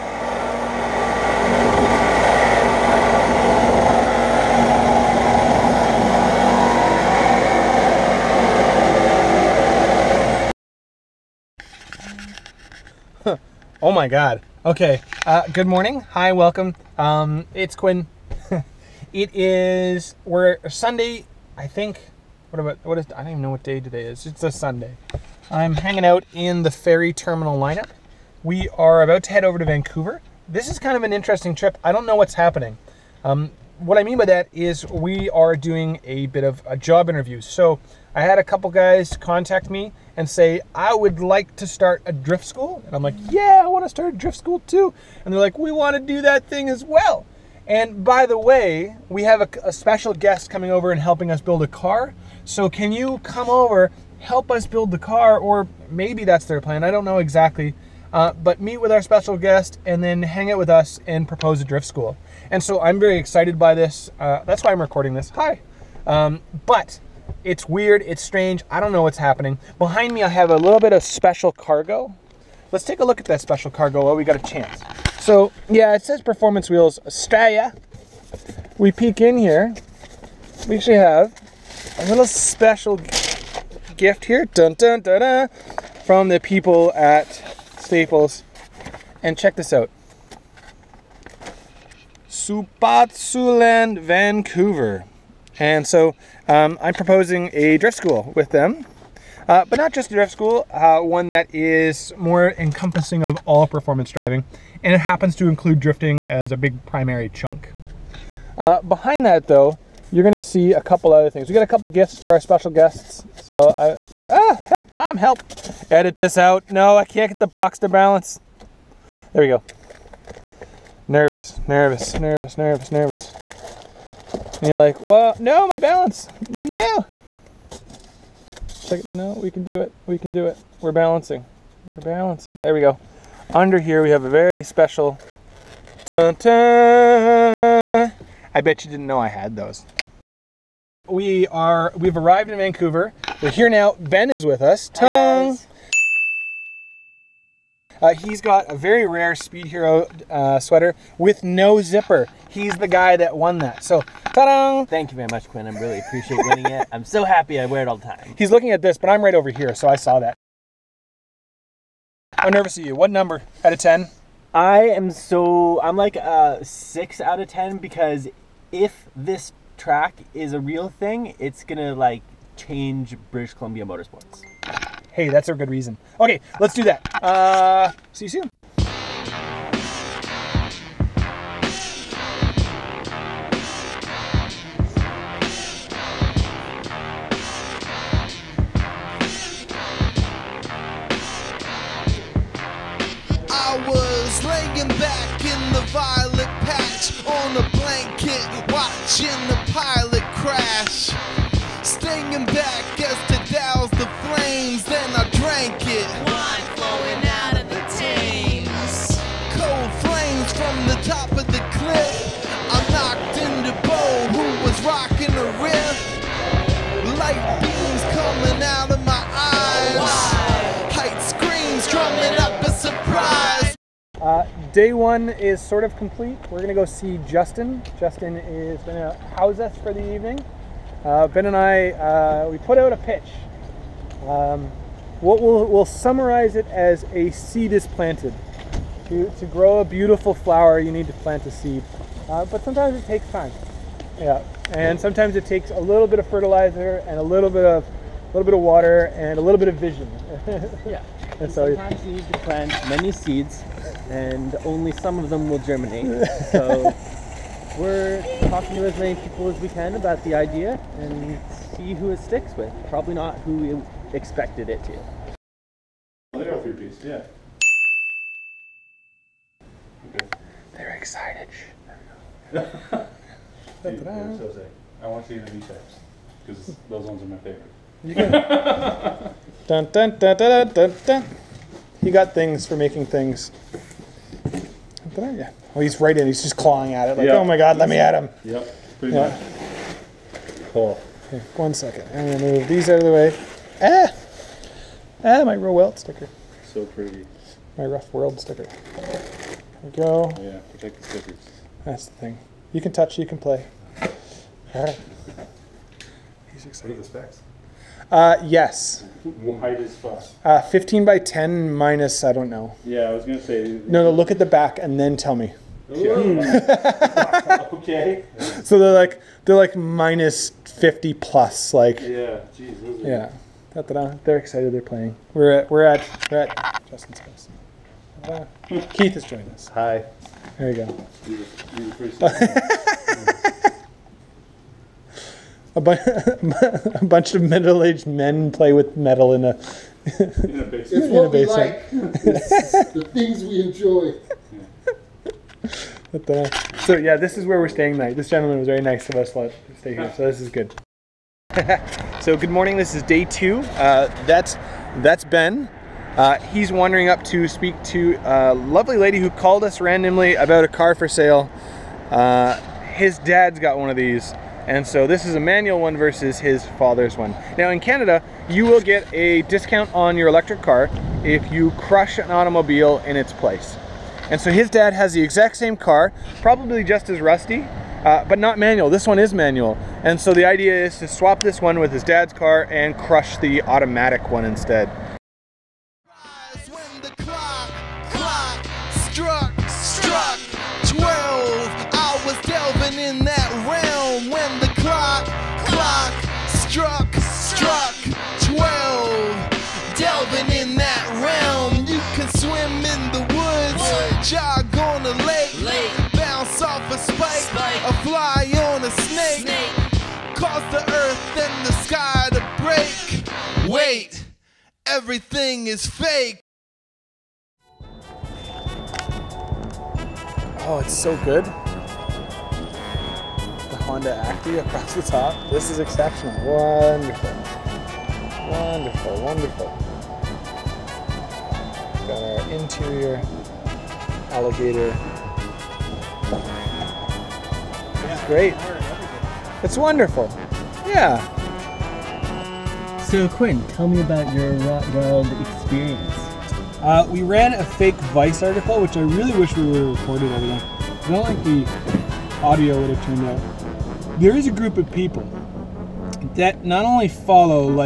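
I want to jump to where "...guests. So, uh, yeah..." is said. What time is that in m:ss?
1:52.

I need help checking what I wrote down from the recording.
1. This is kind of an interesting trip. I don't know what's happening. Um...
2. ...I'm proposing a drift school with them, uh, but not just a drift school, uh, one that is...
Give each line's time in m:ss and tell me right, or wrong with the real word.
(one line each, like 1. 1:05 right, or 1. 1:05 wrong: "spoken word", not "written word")
1. 0:30 right
2. 1:36 right.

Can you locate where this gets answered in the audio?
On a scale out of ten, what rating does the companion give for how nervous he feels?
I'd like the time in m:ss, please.
2:46.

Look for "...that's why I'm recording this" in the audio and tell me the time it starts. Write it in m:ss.
1:04.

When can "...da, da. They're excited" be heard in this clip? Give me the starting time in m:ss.
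5:23.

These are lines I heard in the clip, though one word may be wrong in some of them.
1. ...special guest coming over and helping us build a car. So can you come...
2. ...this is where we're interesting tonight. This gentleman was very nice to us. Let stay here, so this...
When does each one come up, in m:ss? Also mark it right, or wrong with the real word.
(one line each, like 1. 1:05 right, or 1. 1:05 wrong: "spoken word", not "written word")
1. 0:49 right
2. 5:47 wrong: "staying", not "interesting".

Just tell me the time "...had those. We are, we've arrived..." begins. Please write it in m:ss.
2:19.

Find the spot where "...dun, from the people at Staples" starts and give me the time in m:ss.
1:25.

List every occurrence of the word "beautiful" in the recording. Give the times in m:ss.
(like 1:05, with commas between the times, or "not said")
3:59.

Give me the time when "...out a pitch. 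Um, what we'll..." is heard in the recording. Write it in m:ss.
3:52.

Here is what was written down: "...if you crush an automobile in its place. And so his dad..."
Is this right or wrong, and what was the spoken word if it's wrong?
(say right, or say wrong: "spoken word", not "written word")
right.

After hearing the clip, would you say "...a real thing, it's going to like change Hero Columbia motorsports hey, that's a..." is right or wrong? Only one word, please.
wrong.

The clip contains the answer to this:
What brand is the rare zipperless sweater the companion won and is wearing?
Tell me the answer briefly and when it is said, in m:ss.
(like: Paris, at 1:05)
Speed Hero, at 2:29.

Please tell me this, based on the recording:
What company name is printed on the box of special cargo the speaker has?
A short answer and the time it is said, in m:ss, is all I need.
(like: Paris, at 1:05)
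Performance Wheels Australia, at 1:16.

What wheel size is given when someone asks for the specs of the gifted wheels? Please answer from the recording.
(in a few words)
15 by 10.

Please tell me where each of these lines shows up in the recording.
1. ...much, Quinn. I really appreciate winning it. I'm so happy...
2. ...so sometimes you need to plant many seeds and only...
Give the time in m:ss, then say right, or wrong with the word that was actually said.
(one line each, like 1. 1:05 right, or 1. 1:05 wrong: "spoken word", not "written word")
1. 2:35 right
2. 4:11 right.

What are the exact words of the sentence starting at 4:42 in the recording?
He got things for making things.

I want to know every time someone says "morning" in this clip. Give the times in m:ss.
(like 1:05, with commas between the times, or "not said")
0:15, 5:52.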